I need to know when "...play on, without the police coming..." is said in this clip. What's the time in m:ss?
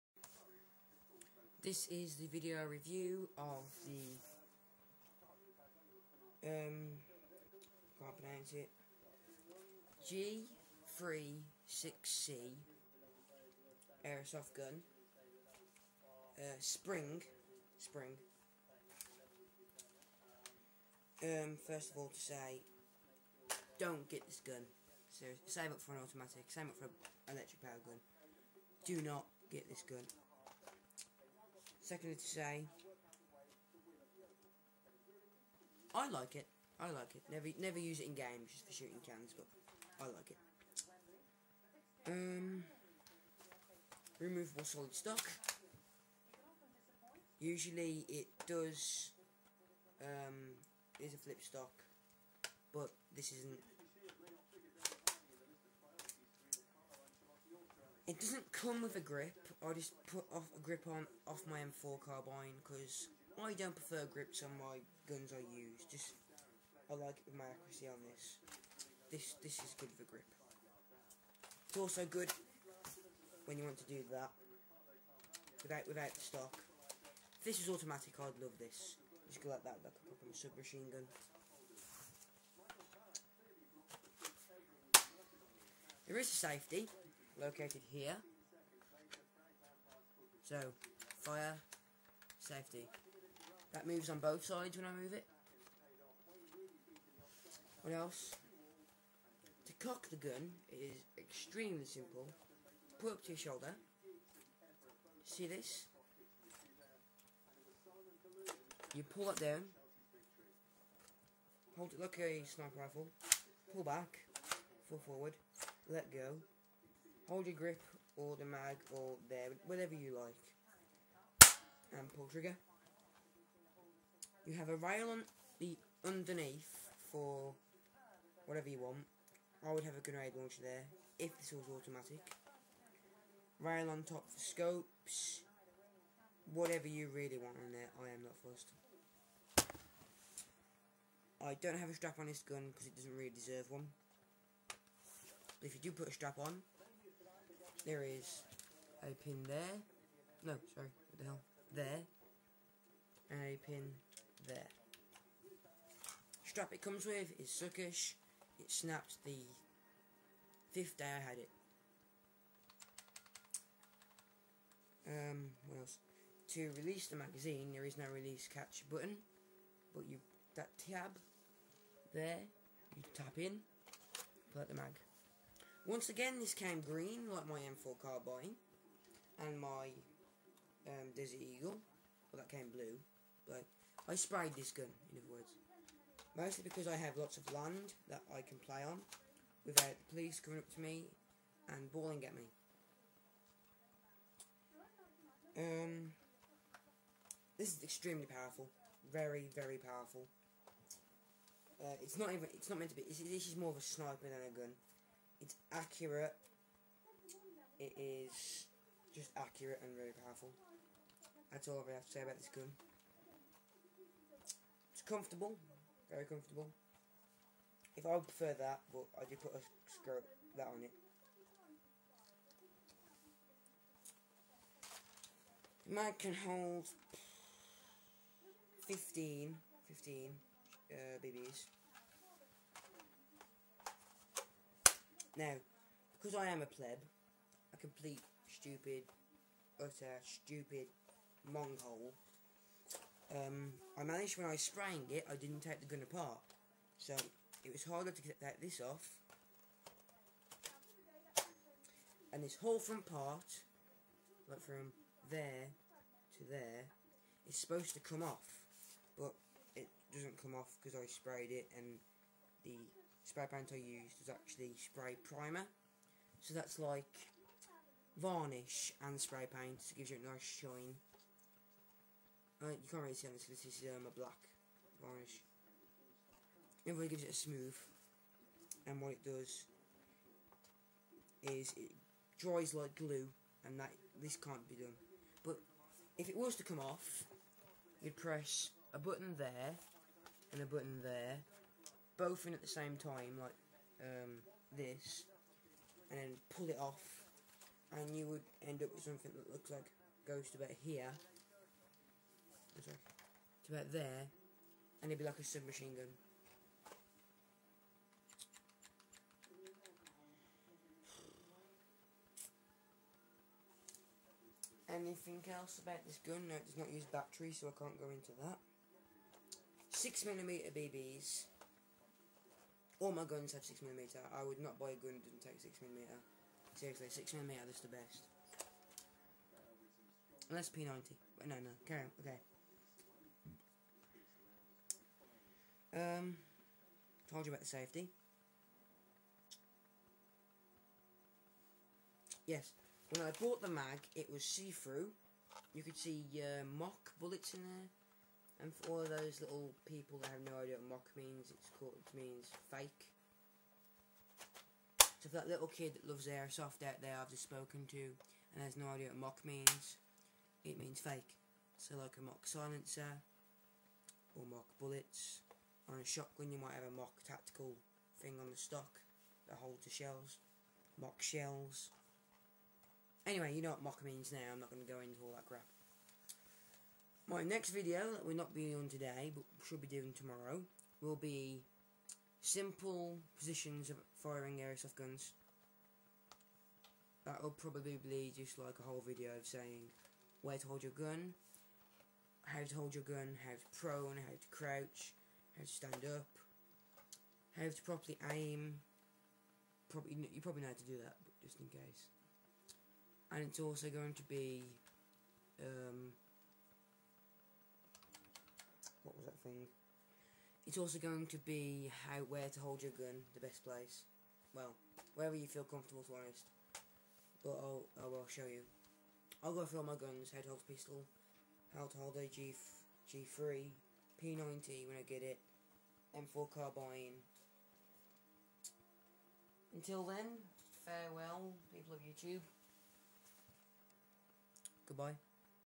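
3:08.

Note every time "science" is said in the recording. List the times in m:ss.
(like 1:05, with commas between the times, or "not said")
not said.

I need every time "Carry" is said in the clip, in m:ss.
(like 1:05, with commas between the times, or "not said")
5:31.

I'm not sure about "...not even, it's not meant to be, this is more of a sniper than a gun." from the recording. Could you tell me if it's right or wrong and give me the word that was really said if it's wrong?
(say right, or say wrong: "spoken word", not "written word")
right.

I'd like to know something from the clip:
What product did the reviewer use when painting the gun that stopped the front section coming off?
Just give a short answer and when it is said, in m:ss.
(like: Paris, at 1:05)
spray primer, at 4:24.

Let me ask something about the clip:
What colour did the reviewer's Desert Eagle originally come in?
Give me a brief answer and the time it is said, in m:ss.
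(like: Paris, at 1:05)
blue, at 3:02.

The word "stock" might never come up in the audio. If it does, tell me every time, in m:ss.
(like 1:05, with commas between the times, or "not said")
0:44, 0:51, 1:16, 6:08.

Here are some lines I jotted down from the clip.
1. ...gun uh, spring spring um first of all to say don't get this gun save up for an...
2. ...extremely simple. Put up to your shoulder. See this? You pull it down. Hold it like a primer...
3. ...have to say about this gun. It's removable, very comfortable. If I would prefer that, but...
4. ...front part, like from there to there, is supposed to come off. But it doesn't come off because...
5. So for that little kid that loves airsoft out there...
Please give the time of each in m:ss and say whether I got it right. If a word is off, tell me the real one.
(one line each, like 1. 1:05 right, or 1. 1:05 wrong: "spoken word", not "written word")
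1. 0:14 right
2. 1:41 wrong: "sniper", not "primer"
3. 3:31 wrong: "comfortable", not "removable"
4. 4:12 right
5. 5:55 right.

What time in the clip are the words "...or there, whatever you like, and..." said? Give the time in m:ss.
1:58.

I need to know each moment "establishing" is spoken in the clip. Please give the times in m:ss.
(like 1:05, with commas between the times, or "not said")
not said.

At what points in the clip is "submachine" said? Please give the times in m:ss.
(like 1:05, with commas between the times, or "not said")
1:20, 5:05.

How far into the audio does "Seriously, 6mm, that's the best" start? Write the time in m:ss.
5:26.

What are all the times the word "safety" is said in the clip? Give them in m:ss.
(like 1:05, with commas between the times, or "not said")
1:26, 1:32, 5:37.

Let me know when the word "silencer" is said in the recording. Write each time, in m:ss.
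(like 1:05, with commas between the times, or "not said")
6:02.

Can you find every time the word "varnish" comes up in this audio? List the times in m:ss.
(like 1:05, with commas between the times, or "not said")
4:28, 4:35.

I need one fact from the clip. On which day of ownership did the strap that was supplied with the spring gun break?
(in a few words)
fifth day.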